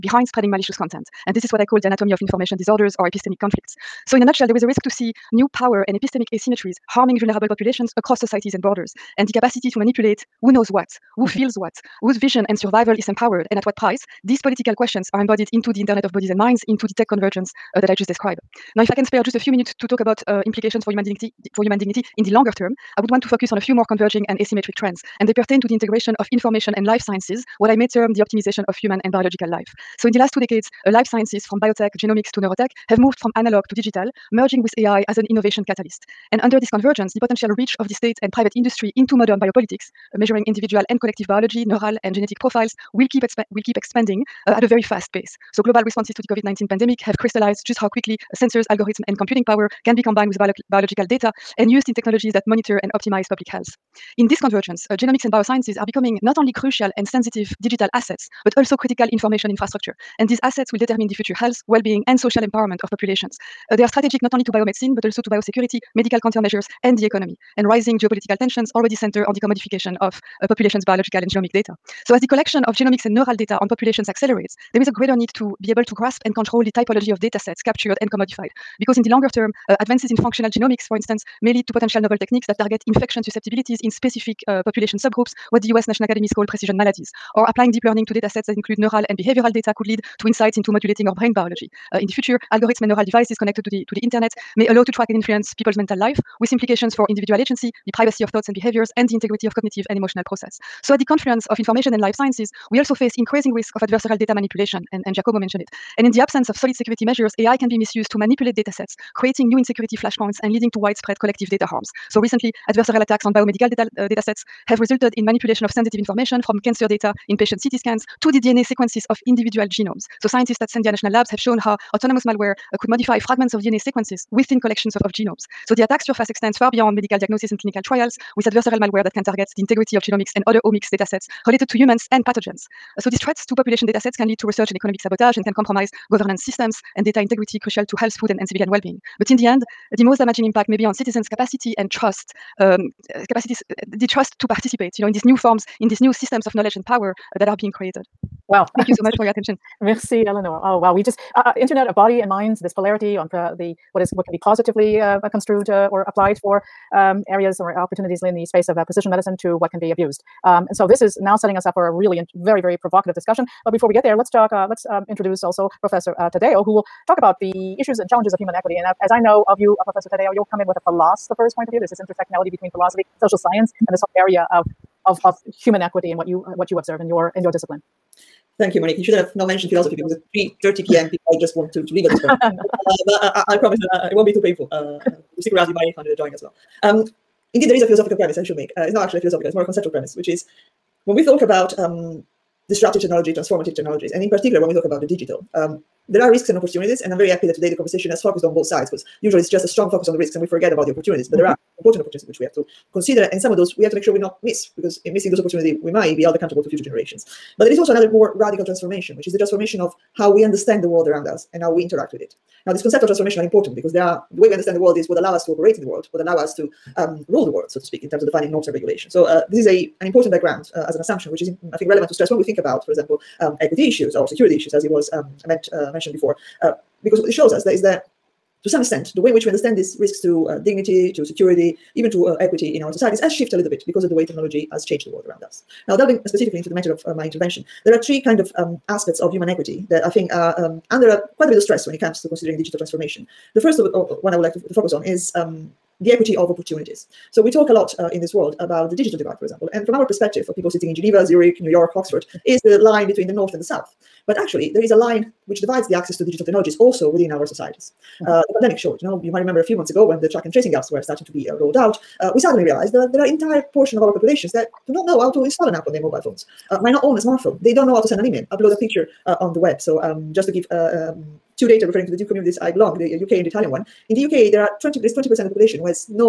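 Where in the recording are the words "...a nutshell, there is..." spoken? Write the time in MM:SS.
00:04.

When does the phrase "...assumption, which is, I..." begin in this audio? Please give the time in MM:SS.
03:41.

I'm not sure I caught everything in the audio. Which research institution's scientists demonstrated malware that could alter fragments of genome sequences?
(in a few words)
Sandia National Labs.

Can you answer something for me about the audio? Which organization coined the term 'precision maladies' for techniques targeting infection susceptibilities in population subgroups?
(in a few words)
US National Academies.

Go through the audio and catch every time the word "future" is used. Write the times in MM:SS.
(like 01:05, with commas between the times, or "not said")
01:01, 01:32, 03:26.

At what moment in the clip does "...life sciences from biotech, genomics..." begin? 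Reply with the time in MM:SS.
00:30.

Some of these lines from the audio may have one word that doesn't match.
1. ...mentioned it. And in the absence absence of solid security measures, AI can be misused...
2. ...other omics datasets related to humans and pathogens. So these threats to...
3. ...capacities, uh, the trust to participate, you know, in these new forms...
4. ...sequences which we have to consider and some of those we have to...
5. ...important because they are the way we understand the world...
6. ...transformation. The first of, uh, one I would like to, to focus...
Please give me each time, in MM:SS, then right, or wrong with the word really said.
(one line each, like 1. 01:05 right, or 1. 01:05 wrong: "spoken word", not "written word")
1. 01:45 right
2. 02:10 right
3. 02:23 right
4. 03:22 wrong: "opportunities", not "sequences"
5. 03:33 right
6. 04:02 right.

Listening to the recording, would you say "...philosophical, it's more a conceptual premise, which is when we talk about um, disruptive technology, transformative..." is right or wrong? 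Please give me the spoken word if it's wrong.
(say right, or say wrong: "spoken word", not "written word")
right.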